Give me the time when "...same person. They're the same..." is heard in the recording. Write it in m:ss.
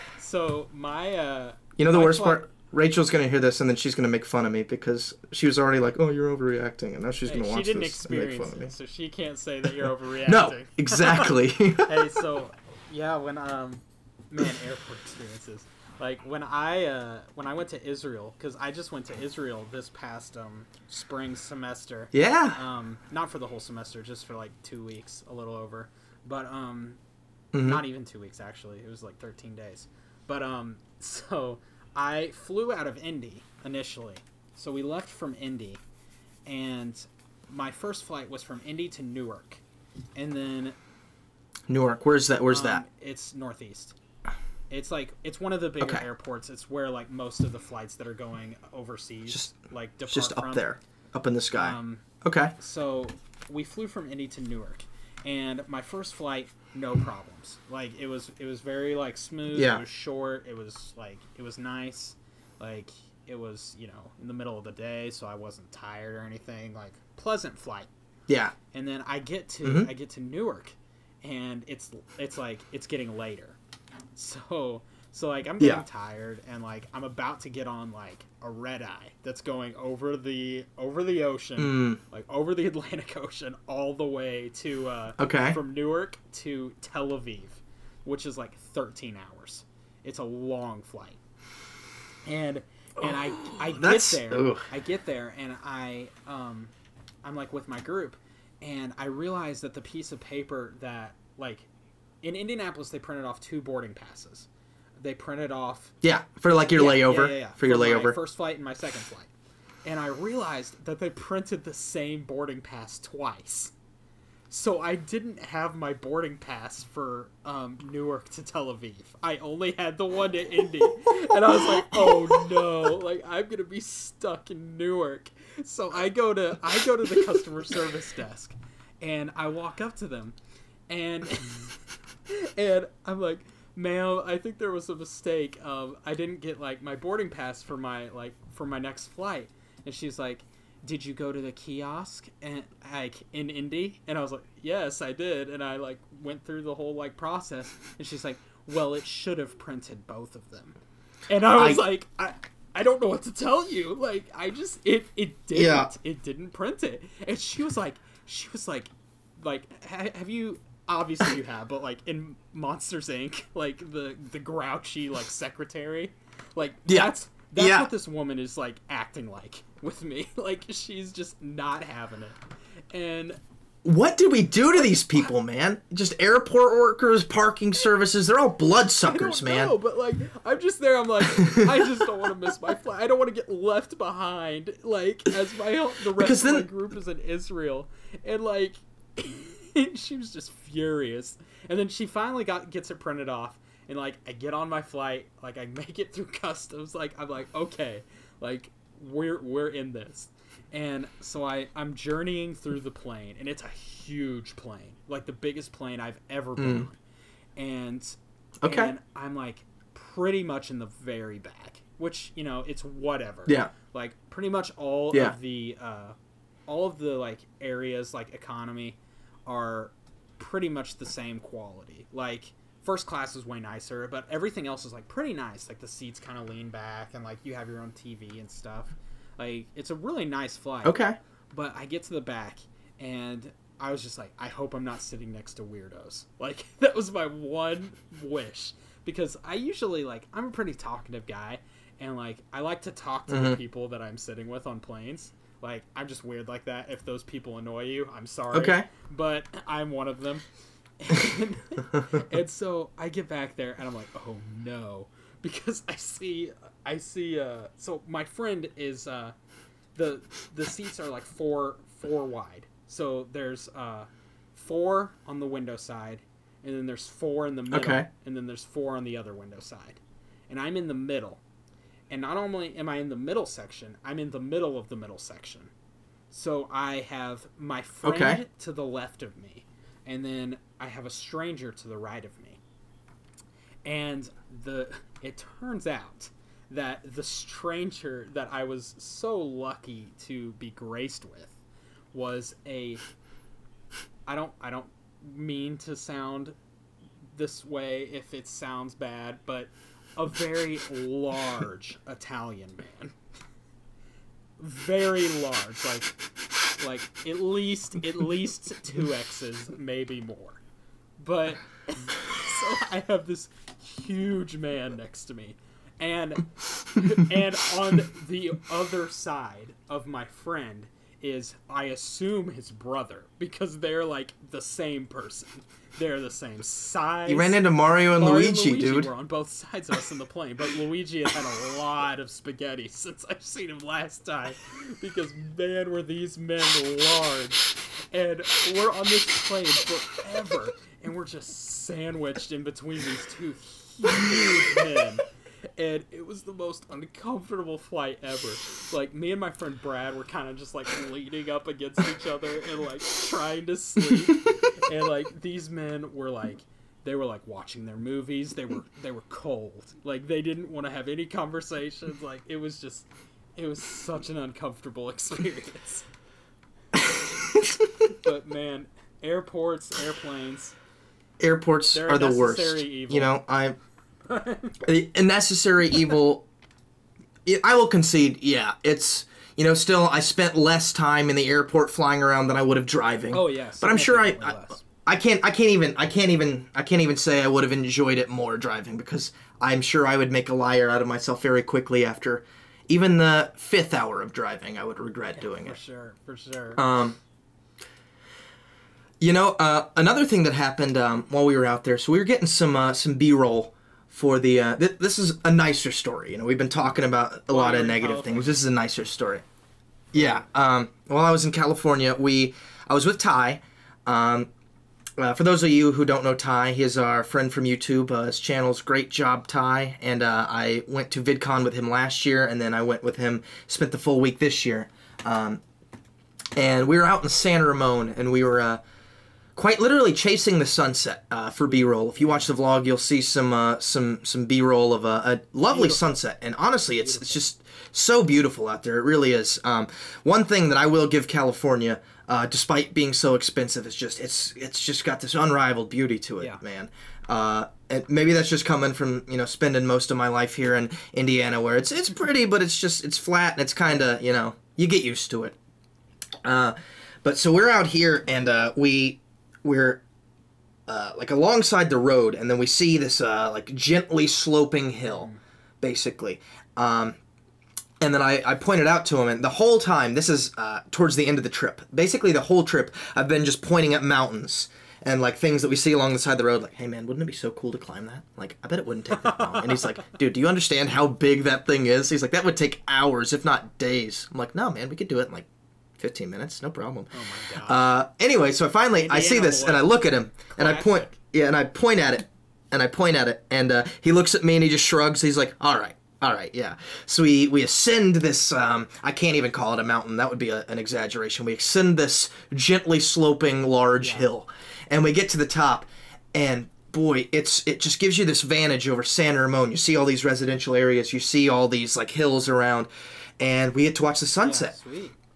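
5:24.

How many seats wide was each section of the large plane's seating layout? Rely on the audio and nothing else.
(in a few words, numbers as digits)
4.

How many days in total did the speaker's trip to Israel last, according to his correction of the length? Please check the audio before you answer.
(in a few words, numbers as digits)
13.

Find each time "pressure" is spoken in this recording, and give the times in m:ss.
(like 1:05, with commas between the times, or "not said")
not said.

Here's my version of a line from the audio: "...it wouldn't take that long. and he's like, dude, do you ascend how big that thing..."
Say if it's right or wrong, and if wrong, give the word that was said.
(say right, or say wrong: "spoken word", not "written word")
wrong: "understand", not "ascend".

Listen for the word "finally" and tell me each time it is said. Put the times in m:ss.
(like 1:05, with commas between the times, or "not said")
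3:12, 8:08.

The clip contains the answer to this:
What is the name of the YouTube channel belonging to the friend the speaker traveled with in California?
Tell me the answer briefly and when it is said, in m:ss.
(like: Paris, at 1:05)
Great Job Ty, at 6:58.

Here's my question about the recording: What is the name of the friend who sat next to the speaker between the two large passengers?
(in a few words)
Brad.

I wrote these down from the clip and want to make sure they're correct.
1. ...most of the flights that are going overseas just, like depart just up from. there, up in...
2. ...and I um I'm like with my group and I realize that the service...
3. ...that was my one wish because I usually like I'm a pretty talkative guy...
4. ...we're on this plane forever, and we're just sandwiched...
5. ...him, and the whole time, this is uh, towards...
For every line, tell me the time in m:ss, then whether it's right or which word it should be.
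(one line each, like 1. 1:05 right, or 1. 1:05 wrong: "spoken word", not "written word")
1. 0:47 right
2. 1:35 wrong: "piece", not "service"
3. 3:56 right
4. 5:38 right
5. 7:49 right.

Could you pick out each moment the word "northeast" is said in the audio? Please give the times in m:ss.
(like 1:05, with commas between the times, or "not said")
0:43.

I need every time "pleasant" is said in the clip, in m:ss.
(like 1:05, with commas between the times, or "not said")
1:07.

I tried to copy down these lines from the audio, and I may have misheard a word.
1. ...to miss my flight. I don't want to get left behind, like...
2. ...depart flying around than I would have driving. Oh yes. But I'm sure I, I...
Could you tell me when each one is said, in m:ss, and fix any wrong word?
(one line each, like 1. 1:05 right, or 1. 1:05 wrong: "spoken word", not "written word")
1. 3:02 right
2. 6:21 wrong: "airport", not "depart".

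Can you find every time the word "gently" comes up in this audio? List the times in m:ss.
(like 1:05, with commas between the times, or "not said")
7:43, 8:22.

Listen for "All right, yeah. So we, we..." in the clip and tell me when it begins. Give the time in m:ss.
8:16.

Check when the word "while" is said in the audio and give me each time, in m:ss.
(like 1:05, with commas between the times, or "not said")
6:41, 6:51.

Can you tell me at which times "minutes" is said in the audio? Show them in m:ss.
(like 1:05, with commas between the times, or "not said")
8:06.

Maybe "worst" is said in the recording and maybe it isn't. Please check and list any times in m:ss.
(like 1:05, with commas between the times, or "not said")
0:01, 6:12.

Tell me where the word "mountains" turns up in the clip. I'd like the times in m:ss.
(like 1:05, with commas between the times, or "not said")
7:54, 8:19.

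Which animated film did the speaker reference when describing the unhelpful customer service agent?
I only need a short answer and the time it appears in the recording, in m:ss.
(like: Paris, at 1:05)
Monsters Inc., at 2:42.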